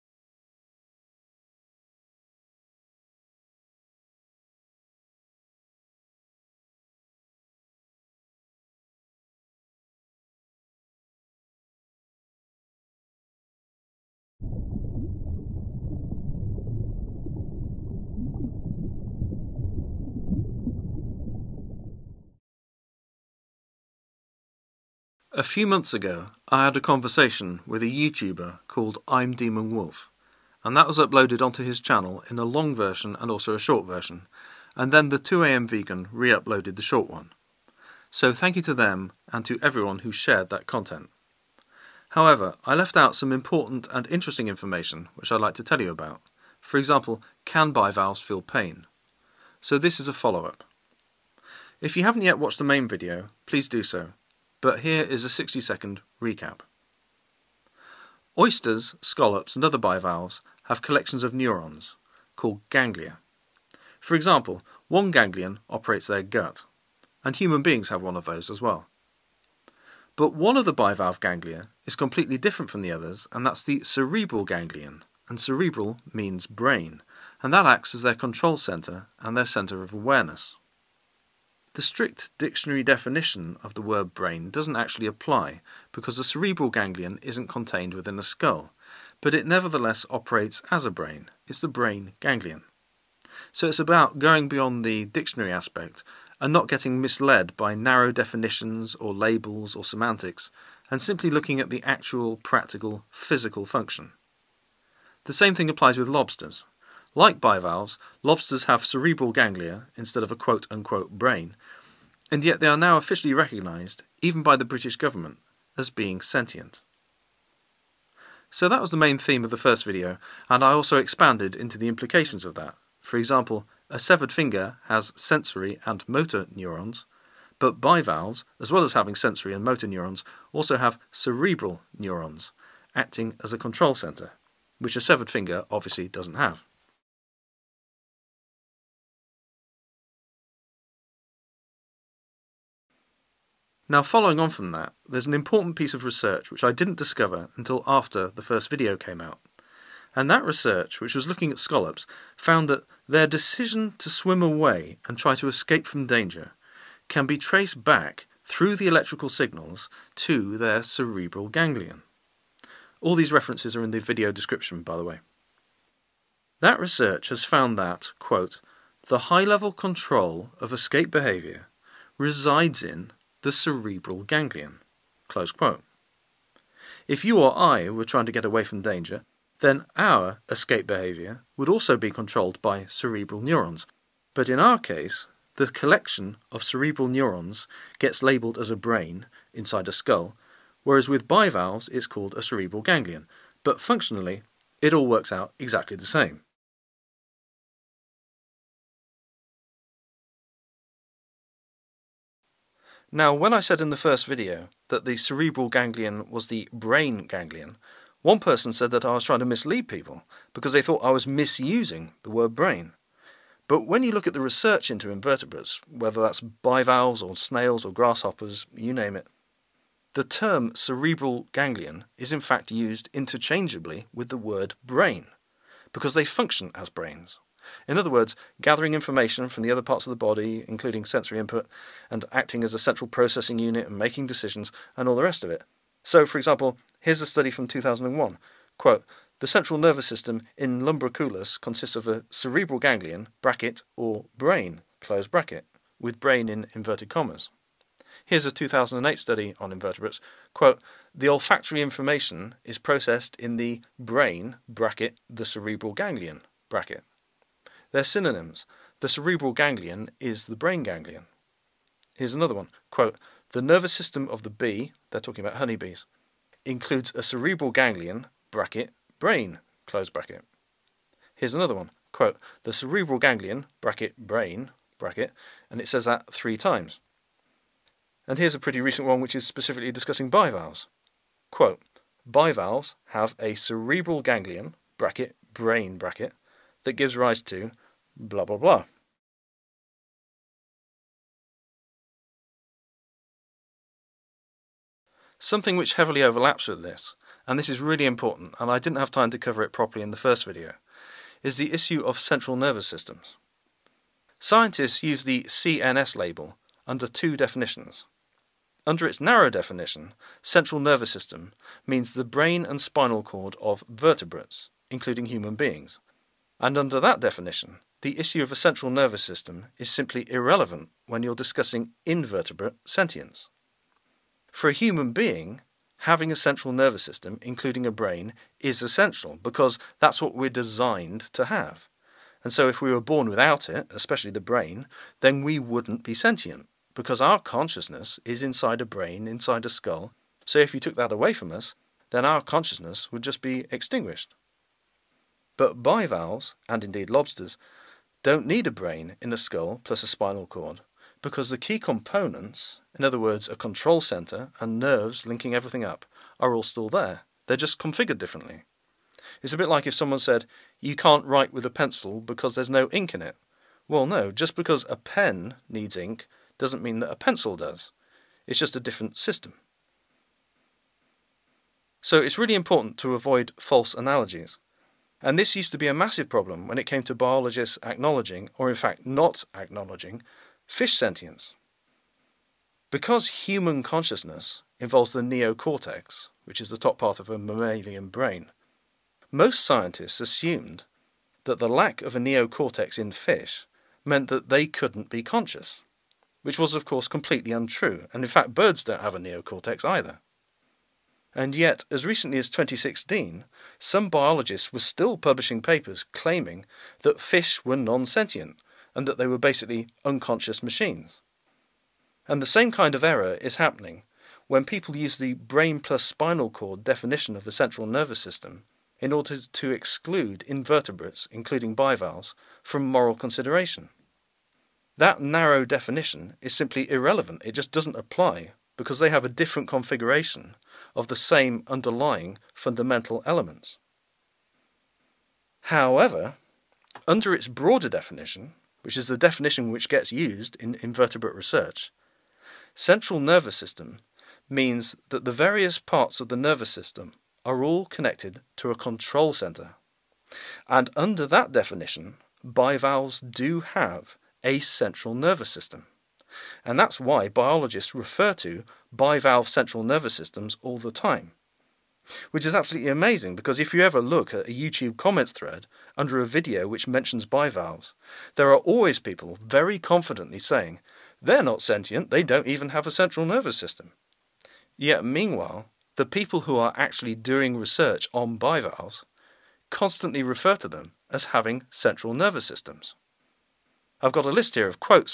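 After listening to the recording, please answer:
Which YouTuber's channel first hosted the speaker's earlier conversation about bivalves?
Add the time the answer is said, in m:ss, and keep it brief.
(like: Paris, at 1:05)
I'm Demon Wolf, at 0:29.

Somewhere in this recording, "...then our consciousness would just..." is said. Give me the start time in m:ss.
5:42.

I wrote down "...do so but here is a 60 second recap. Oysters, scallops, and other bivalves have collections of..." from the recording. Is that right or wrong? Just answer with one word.
right.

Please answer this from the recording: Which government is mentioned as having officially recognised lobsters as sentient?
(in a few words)
British government.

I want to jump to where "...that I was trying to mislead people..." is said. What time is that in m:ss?
3:28.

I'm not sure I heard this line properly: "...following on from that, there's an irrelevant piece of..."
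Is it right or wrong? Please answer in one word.
wrong.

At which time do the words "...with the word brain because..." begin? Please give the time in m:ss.
3:44.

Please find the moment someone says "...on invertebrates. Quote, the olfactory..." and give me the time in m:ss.
4:09.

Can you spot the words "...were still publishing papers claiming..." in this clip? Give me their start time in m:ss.
6:44.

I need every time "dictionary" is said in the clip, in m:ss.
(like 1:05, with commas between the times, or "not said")
1:22, 1:35.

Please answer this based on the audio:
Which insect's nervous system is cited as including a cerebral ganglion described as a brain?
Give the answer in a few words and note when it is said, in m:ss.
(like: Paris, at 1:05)
honeybees, at 4:25.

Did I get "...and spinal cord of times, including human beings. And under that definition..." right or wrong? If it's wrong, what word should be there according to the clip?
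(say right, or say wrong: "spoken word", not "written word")
wrong: "vertebrates", not "times".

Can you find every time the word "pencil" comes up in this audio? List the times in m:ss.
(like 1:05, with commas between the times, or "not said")
6:01, 6:07.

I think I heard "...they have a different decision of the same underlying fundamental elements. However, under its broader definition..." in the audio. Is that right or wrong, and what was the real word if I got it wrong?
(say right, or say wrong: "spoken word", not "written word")
wrong: "configuration", not "decision".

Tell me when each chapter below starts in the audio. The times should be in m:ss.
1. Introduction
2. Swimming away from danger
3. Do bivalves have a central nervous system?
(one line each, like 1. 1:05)
1. 0:22
2. 2:02
3. 4:34.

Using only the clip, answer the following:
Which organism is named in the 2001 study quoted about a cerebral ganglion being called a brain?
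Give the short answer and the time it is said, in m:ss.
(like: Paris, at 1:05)
lumbriculus, at 4:00.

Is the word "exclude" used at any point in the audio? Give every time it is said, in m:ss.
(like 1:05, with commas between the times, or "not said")
6:59.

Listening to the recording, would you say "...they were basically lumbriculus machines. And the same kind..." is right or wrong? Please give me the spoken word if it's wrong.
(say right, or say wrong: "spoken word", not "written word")
wrong: "unconscious", not "lumbriculus".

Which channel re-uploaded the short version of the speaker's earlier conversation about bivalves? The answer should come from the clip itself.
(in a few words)
the 2am vegan.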